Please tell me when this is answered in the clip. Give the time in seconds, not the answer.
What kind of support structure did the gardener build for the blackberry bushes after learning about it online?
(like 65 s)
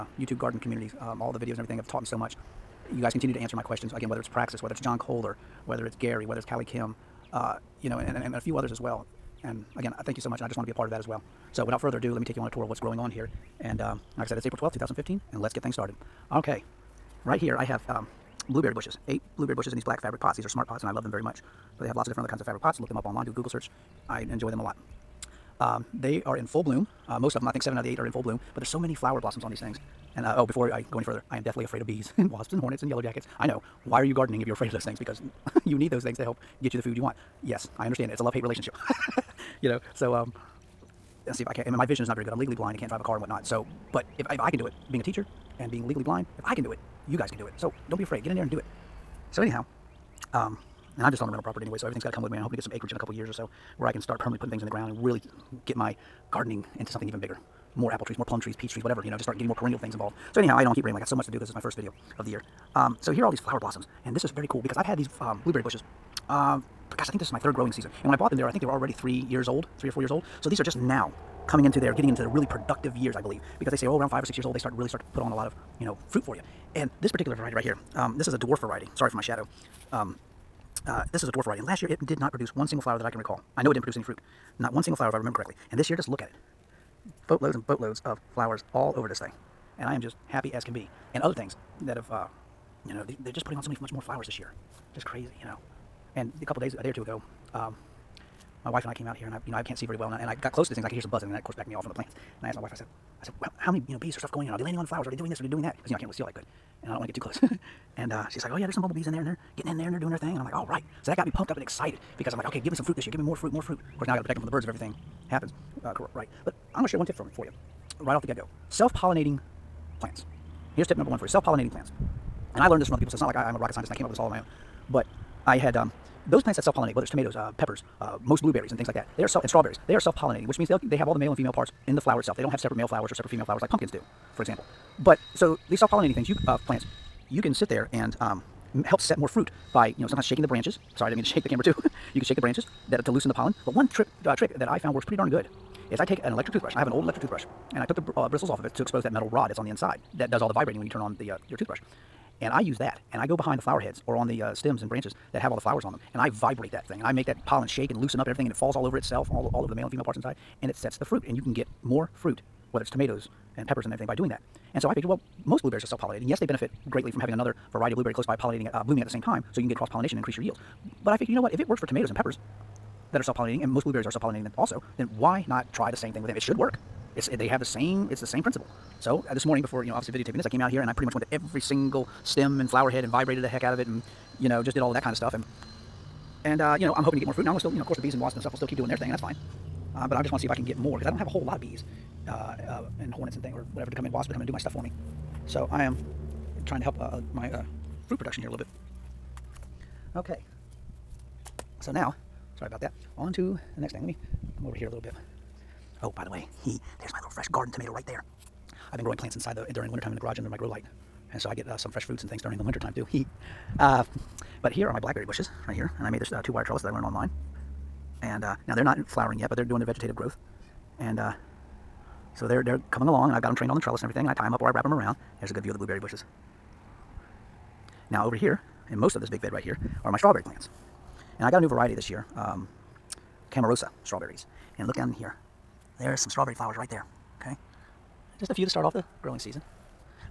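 216 s.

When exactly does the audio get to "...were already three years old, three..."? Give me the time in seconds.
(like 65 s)
68 s.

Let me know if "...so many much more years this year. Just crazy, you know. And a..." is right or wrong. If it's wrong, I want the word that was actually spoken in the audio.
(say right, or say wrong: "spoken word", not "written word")
wrong: "flowers", not "years".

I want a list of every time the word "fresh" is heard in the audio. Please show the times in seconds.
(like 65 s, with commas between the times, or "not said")
207 s, 211 s.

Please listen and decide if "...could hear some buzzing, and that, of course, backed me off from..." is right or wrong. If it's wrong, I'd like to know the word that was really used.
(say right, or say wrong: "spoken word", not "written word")
right.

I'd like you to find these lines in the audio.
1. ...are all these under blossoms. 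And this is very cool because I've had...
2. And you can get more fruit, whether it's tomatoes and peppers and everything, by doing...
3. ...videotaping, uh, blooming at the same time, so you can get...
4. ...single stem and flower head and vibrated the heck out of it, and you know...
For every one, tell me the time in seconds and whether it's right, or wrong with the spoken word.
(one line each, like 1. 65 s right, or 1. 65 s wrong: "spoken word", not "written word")
1. 63 s wrong: "flower", not "under"
2. 161 s right
3. 168 s wrong: "pollinating", not "videotaping"
4. 181 s right.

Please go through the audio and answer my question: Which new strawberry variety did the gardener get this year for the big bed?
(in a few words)
Camarosa.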